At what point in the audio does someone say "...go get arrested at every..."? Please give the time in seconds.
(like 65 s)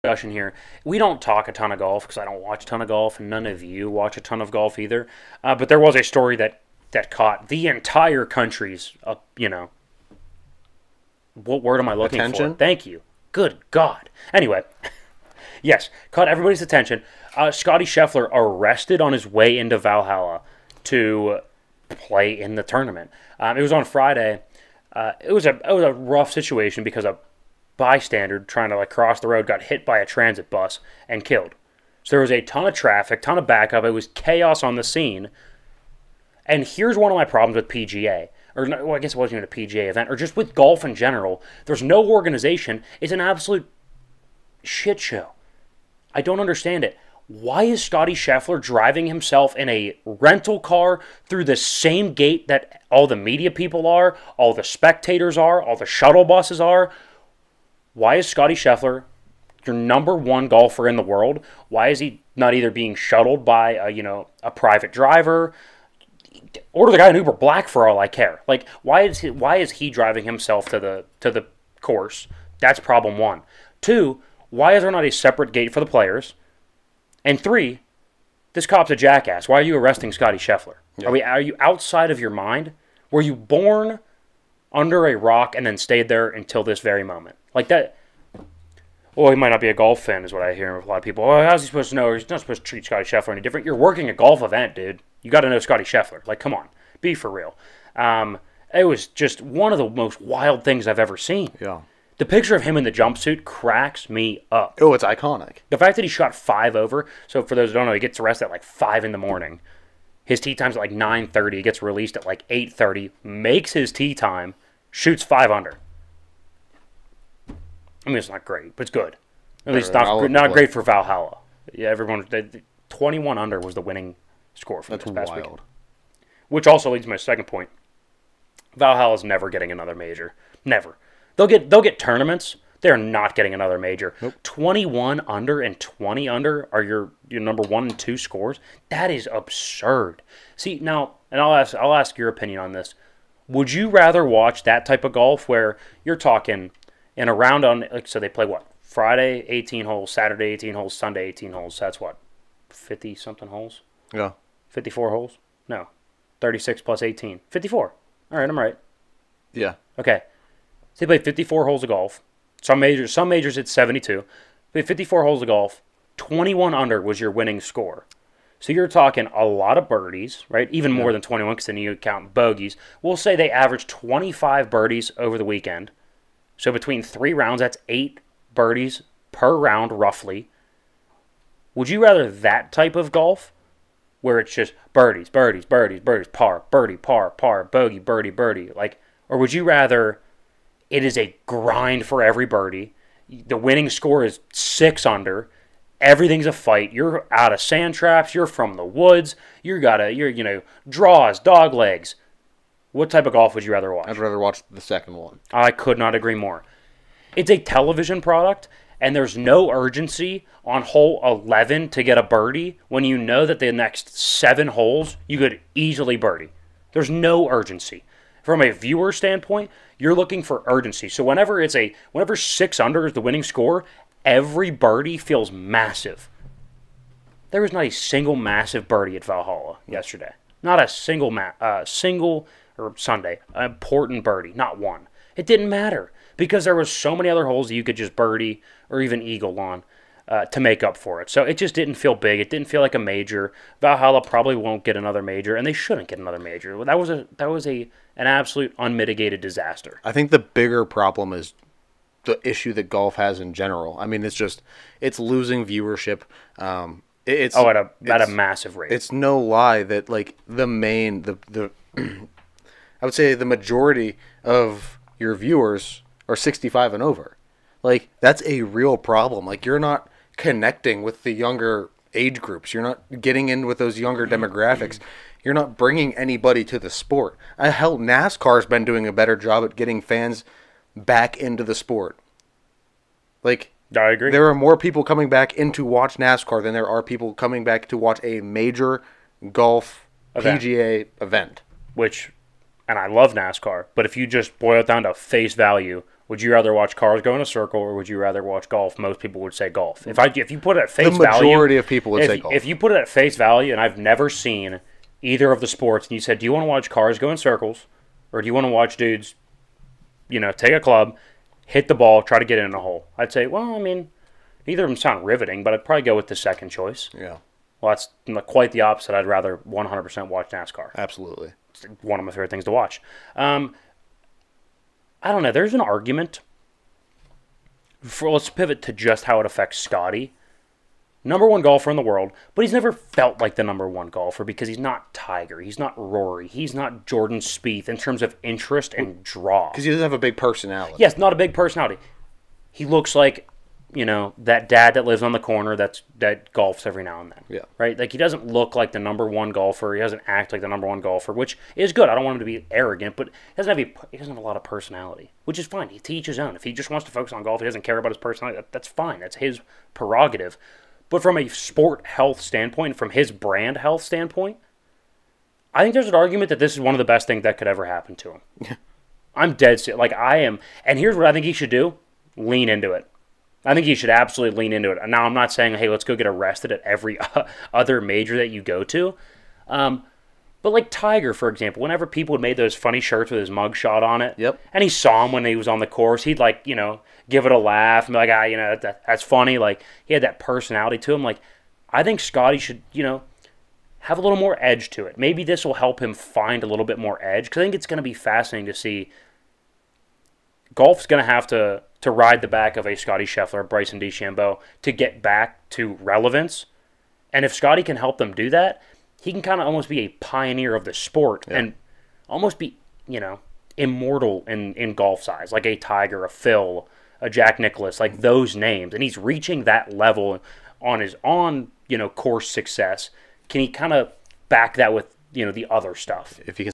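376 s.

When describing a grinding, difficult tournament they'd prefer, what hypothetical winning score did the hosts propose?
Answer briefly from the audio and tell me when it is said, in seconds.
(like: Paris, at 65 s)
6 under, at 194 s.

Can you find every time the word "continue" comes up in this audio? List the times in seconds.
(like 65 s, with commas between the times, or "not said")
not said.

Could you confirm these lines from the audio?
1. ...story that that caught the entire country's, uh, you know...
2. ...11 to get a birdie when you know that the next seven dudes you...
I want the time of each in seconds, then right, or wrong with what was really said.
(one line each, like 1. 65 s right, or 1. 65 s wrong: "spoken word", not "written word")
1. 6 s right
2. 211 s wrong: "holes", not "dudes".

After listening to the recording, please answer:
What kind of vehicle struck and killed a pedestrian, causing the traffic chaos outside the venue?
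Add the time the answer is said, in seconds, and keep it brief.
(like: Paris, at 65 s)
transit bus, at 30 s.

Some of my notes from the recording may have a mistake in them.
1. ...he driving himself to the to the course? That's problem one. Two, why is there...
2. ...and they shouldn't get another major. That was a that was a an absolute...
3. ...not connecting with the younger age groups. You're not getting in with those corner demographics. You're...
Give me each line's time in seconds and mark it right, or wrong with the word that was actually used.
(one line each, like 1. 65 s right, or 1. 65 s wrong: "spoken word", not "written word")
1. 69 s right
2. 245 s right
3. 269 s wrong: "younger", not "corner".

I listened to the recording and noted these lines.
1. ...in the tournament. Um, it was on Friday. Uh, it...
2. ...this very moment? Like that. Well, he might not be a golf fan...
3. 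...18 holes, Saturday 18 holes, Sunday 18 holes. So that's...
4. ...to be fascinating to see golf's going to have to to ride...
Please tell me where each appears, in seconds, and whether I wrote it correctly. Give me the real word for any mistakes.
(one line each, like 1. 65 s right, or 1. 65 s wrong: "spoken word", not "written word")
1. 22 s right
2. 86 s right
3. 149 s right
4. 397 s right.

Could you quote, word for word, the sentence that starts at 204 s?
I'd rather watch the second one.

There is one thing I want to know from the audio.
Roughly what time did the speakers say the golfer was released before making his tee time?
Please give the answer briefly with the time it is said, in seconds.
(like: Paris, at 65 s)
8:30, at 112 s.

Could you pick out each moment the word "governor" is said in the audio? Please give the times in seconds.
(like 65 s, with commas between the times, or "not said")
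not said.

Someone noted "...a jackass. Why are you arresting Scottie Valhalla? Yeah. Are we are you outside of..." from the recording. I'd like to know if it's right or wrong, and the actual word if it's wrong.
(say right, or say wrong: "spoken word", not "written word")
wrong: "Scheffler", not "Valhalla".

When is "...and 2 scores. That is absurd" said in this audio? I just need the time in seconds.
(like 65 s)
137 s.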